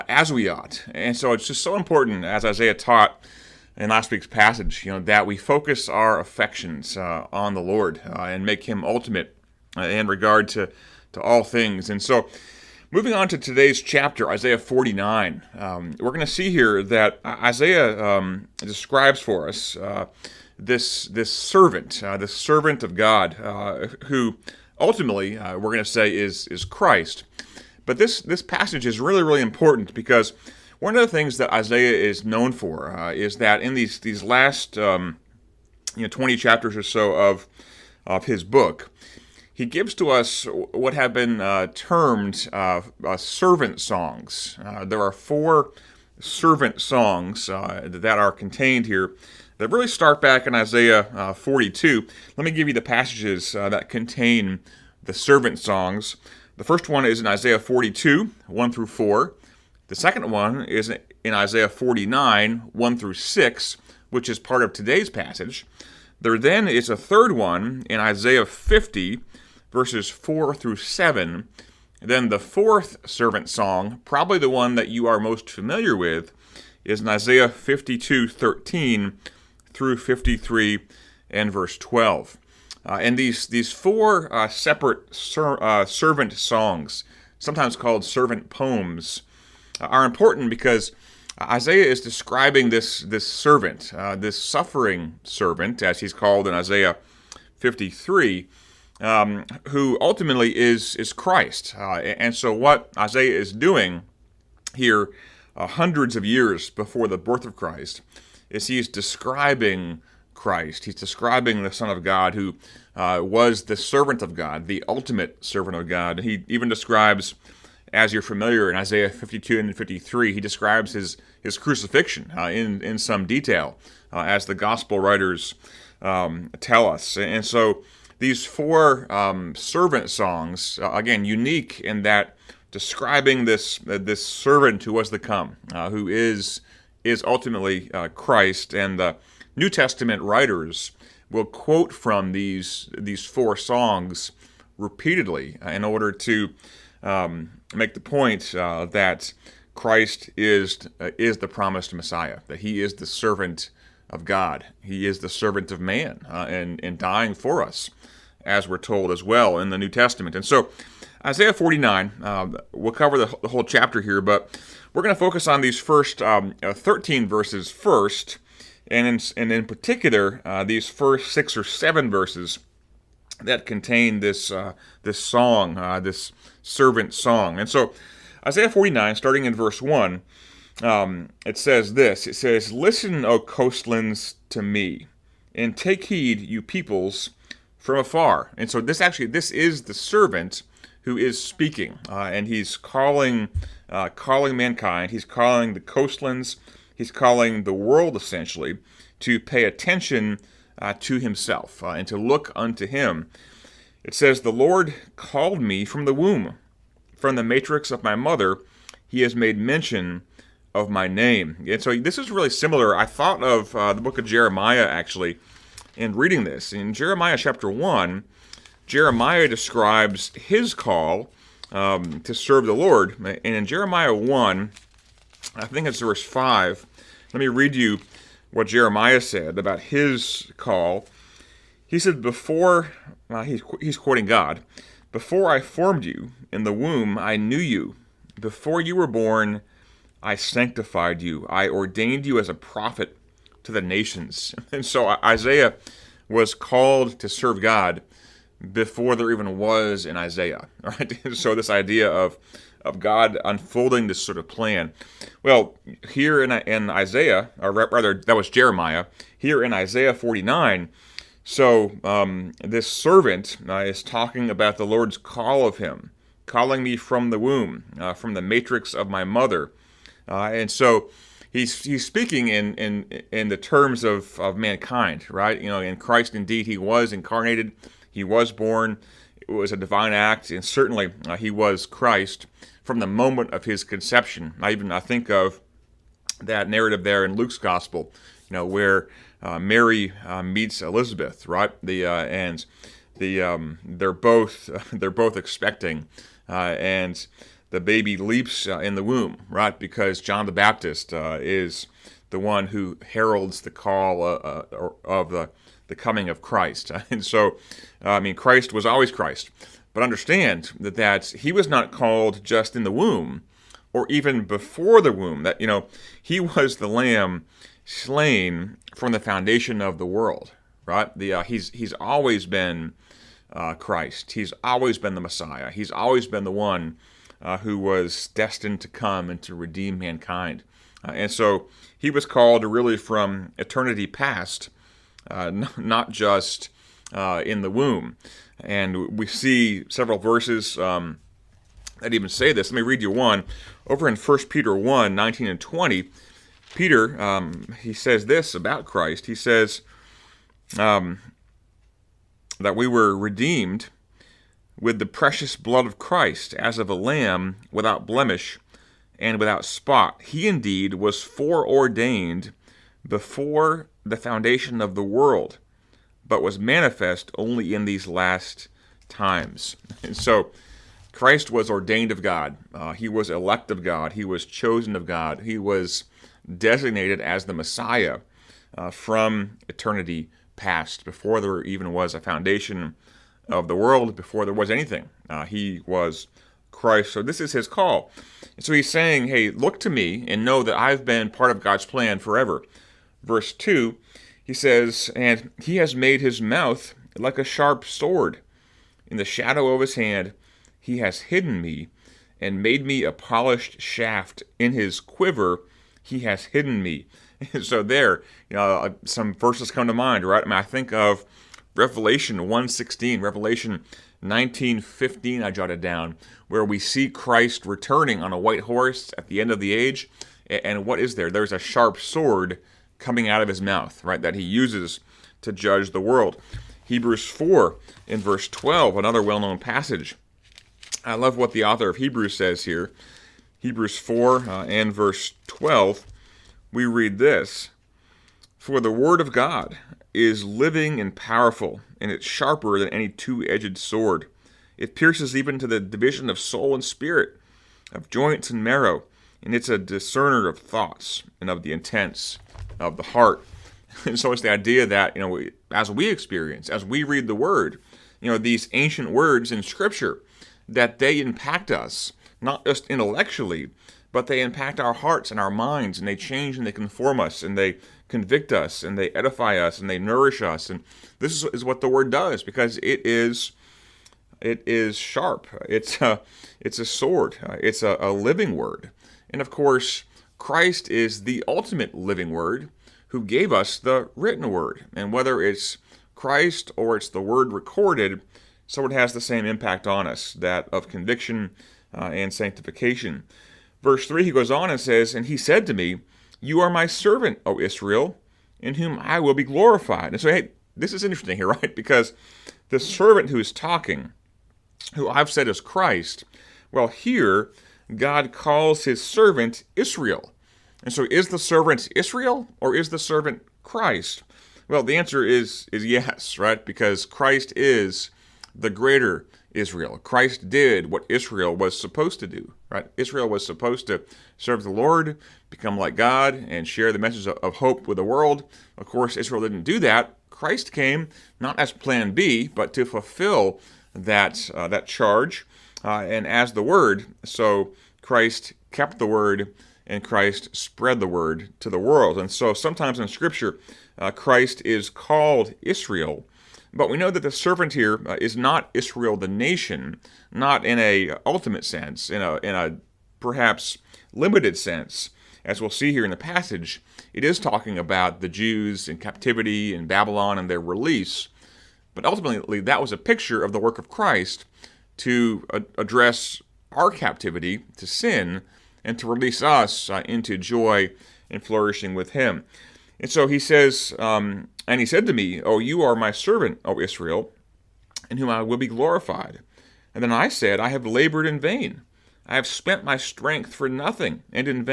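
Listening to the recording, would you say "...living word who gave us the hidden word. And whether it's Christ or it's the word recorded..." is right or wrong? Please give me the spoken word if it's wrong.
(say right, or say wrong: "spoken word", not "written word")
wrong: "written", not "hidden".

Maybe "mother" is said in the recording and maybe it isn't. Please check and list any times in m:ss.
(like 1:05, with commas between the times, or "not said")
3:28, 4:29.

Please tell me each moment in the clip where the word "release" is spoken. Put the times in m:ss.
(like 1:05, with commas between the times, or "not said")
9:20, 9:29.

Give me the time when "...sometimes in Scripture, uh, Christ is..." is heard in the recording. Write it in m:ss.
9:02.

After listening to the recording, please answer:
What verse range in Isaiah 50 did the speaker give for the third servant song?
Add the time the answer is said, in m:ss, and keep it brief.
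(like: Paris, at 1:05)
4 through 7, at 1:09.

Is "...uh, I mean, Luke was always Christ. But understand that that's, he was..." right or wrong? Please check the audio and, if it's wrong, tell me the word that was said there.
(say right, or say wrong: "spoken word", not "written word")
wrong: "Christ", not "Luke".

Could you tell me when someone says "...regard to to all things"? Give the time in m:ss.
0:10.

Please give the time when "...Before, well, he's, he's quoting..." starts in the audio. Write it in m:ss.
3:52.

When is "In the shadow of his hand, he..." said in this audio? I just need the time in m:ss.
6:39.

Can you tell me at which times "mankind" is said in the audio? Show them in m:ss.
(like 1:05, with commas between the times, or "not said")
3:14, 4:34, 5:29.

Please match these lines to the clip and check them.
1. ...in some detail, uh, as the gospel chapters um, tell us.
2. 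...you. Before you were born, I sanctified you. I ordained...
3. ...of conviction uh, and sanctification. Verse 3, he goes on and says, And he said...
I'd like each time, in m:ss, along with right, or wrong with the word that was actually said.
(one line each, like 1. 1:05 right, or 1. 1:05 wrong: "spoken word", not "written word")
1. 2:02 wrong: "writers", not "chapters"
2. 3:57 right
3. 8:10 right.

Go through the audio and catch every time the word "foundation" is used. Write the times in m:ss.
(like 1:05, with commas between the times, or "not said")
5:19, 6:04, 6:22.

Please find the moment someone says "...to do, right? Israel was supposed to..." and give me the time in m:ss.
8:42.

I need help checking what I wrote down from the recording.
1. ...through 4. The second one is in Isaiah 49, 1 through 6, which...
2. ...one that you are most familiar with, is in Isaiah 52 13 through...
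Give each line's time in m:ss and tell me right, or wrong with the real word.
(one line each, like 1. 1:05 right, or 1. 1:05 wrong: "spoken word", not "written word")
1. 0:58 right
2. 1:14 right.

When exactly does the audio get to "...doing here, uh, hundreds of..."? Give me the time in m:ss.
1:43.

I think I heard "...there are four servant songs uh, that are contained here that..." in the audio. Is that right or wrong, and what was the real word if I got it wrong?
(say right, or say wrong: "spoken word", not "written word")
right.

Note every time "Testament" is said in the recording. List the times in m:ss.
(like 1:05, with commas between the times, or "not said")
2:19, 2:39.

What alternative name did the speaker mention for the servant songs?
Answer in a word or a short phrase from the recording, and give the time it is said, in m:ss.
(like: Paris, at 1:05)
Servant poems, at 1:28.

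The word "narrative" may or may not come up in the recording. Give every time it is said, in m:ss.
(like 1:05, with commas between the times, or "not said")
4:46.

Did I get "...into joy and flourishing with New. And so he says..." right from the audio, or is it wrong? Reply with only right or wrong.
wrong.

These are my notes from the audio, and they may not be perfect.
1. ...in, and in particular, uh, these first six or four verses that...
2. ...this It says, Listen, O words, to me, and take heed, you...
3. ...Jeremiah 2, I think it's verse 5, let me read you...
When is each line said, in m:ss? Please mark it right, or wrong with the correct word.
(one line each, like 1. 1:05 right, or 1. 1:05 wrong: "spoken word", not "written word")
1. 2:49 wrong: "seven", not "four"
2. 3:01 wrong: "coastlands", not "words"
3. 3:43 wrong: "1", not "2".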